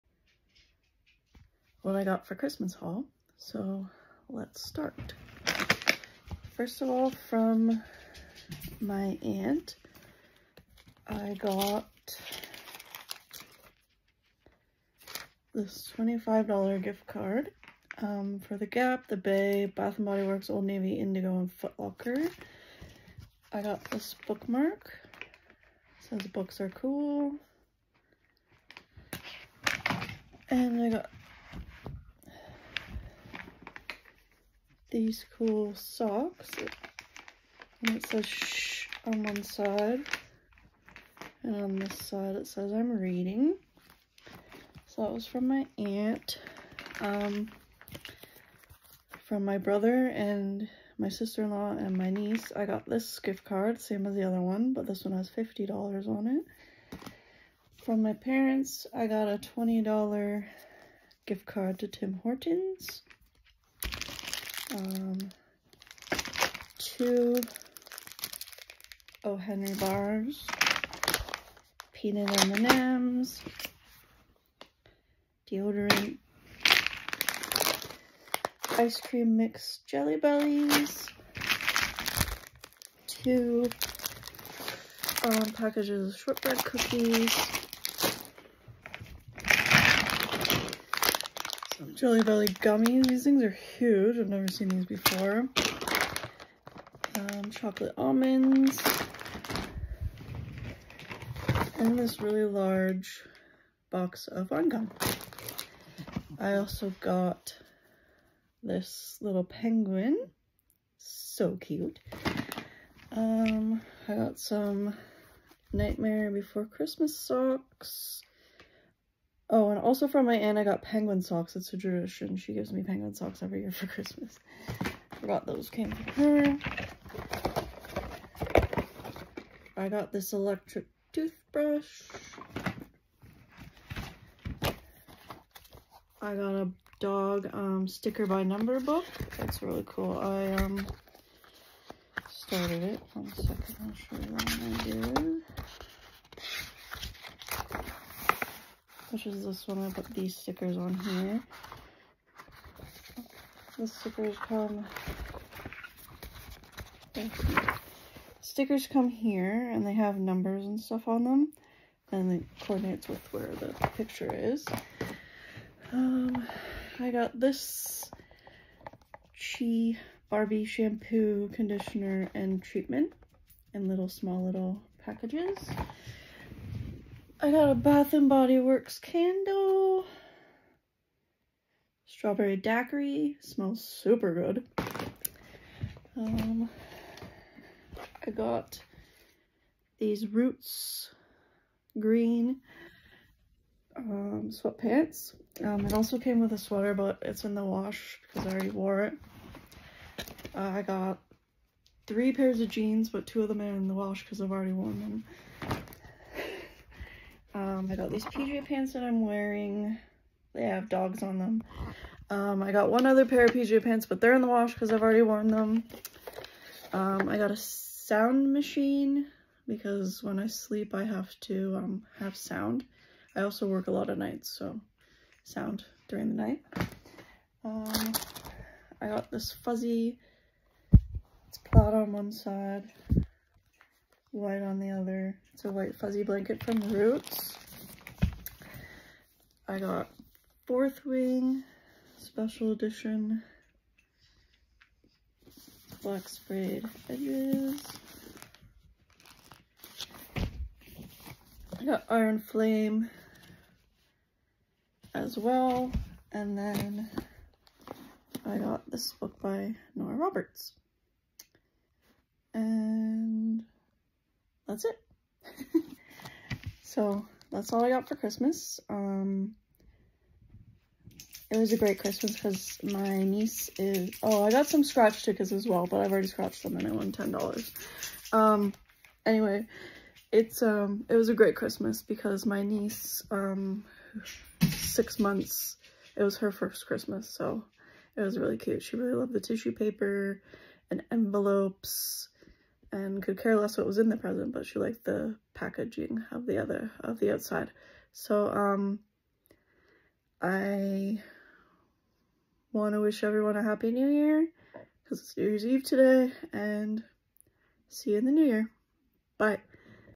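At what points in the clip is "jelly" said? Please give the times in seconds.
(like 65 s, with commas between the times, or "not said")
79 s, 92 s.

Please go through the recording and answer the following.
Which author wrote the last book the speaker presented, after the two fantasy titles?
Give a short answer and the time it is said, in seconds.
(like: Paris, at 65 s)
Nora Roberts, at 259 s.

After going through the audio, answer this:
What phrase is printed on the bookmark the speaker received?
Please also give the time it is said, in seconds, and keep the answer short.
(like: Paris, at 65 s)
books are cool, at 26 s.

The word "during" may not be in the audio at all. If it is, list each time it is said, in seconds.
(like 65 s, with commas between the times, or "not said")
226 s.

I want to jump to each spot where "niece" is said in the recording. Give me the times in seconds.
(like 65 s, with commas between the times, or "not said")
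52 s, 273 s, 282 s.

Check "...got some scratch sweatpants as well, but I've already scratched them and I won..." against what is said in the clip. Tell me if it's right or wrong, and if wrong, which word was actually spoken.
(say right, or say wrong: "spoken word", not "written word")
wrong: "tickets", not "sweatpants".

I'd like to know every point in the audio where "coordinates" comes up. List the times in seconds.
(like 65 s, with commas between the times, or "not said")
162 s.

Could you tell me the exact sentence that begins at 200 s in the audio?
Uh, I got three pairs of jeans, but two of them are in the wash because I've already worn them.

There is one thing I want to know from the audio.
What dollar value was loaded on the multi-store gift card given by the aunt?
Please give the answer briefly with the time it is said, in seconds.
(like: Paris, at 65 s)
$25, at 15 s.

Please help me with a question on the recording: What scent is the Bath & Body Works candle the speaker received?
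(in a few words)
Strawberry daiquiri.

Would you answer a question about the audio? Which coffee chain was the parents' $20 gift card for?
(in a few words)
Tim Hortons.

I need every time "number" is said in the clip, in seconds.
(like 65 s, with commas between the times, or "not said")
138 s, 160 s.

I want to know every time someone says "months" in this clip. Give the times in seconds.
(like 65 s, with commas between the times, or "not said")
285 s.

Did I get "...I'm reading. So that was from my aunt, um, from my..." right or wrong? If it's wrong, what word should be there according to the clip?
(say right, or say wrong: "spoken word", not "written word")
right.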